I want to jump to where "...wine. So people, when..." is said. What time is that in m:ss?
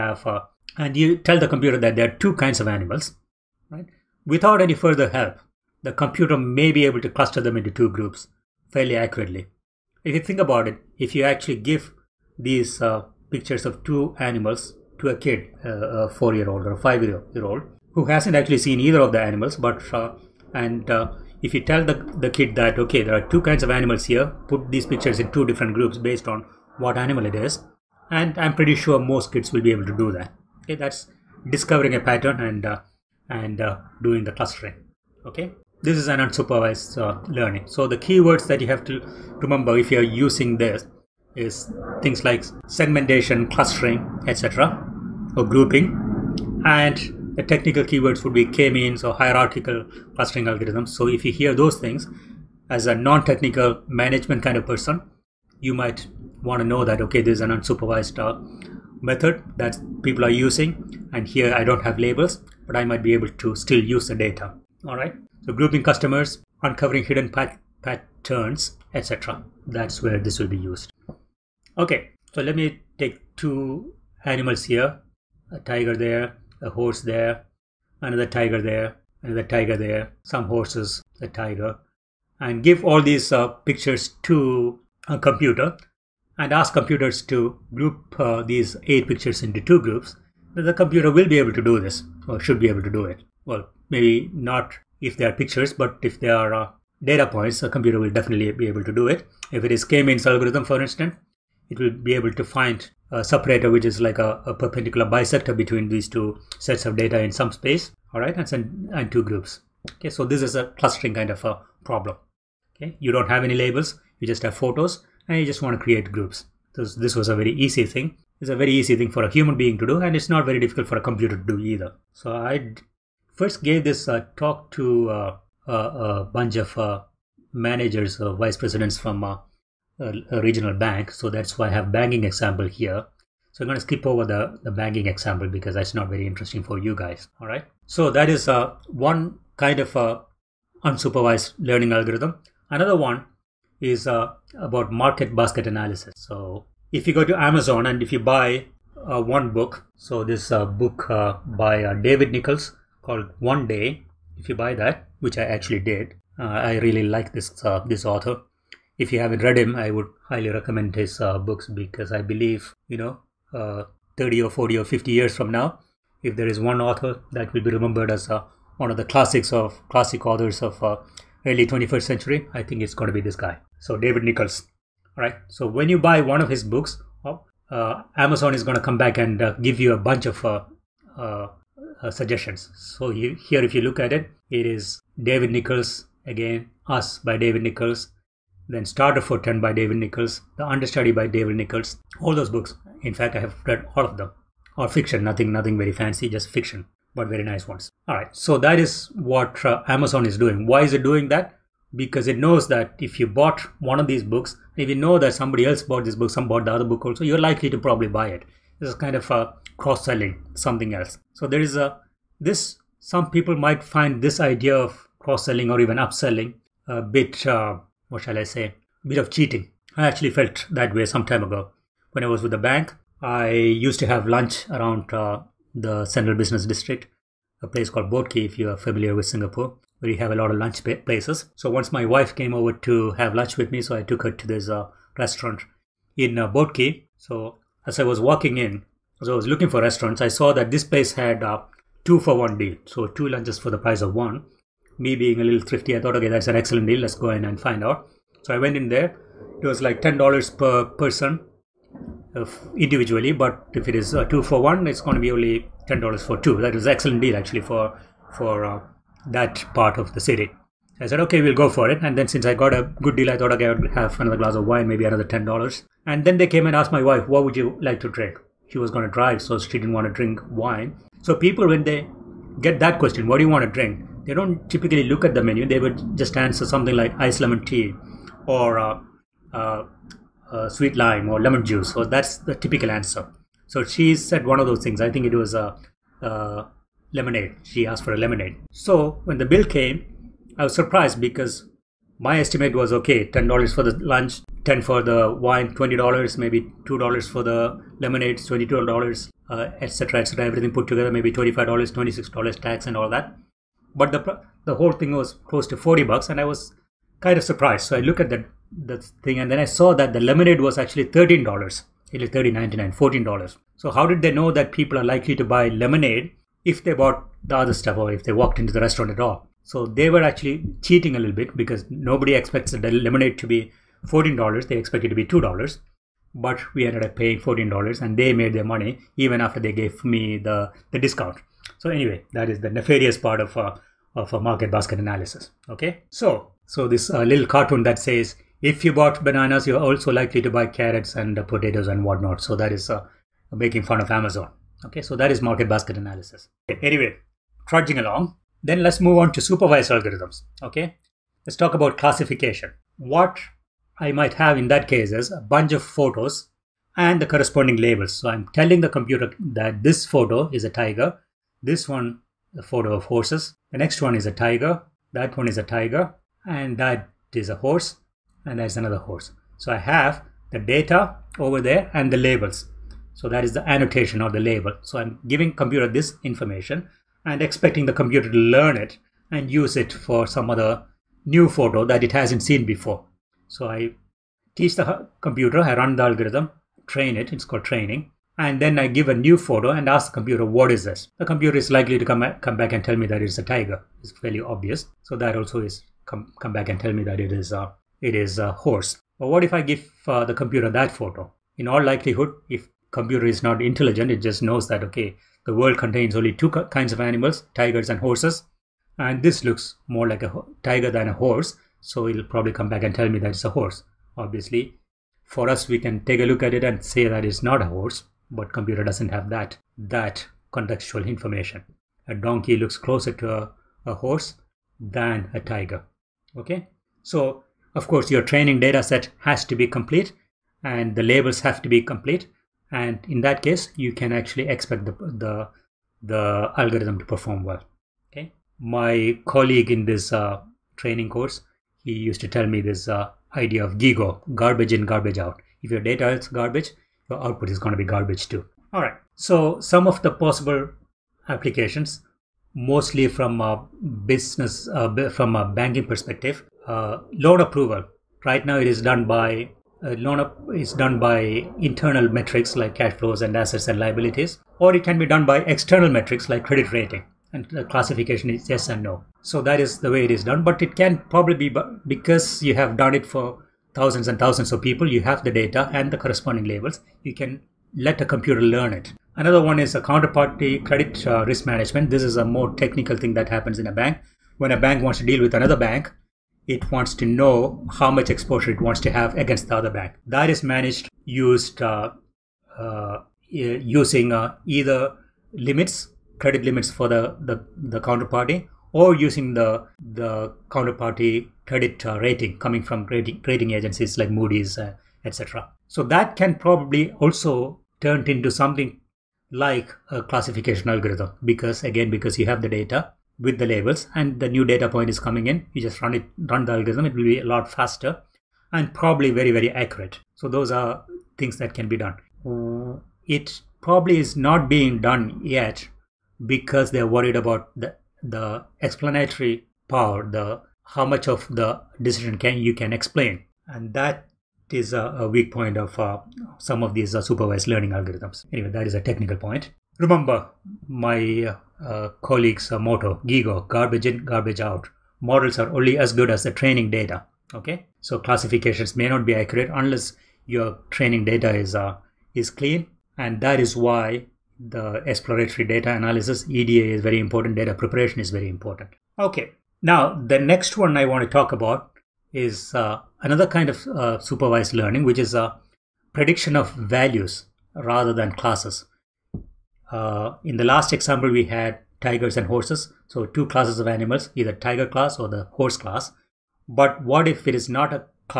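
4:30.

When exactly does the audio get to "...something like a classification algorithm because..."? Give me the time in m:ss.
8:28.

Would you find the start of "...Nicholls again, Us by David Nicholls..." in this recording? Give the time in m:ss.
3:05.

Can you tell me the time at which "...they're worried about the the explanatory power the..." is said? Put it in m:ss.
8:46.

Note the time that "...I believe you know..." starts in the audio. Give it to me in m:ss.
2:42.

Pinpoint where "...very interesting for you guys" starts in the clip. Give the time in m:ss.
2:16.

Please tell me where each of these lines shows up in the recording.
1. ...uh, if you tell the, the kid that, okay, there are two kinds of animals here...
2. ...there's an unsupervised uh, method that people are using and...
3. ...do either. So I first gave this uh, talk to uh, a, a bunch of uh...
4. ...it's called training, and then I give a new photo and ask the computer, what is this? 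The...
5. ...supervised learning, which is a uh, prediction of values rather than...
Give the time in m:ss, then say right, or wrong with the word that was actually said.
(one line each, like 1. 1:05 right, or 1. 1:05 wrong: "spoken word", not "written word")
1. 0:20 right
2. 0:57 right
3. 2:01 right
4. 6:27 right
5. 9:23 right.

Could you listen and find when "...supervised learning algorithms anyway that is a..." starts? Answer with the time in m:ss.
8:57.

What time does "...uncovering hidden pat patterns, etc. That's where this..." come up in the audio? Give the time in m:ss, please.
1:06.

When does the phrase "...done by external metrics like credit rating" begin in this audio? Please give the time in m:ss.
7:45.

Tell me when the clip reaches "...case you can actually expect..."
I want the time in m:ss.
7:13.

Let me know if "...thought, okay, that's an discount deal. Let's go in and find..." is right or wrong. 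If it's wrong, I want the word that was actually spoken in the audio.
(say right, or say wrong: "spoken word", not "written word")
wrong: "excellent", not "discount".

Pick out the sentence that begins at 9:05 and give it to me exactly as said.
Models are only as good as the training data.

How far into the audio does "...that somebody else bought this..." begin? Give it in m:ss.
3:25.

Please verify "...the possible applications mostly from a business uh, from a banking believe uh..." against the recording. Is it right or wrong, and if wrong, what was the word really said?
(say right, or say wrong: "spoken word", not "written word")
wrong: "perspective", not "believe".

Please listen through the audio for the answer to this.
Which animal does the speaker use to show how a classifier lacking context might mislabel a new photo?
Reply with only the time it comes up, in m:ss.
7:02.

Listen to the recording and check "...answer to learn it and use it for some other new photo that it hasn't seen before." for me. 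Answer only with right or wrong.
wrong.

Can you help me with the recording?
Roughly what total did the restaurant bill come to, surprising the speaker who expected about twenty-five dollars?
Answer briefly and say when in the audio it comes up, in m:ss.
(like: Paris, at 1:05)
$40, at 5:05.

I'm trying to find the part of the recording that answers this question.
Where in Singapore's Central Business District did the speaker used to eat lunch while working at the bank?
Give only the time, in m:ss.
3:48.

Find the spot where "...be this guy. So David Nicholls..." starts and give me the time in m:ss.
2:53.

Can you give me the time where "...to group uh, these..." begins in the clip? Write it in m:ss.
1:27.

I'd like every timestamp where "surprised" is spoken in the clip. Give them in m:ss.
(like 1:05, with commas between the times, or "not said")
4:50, 5:07.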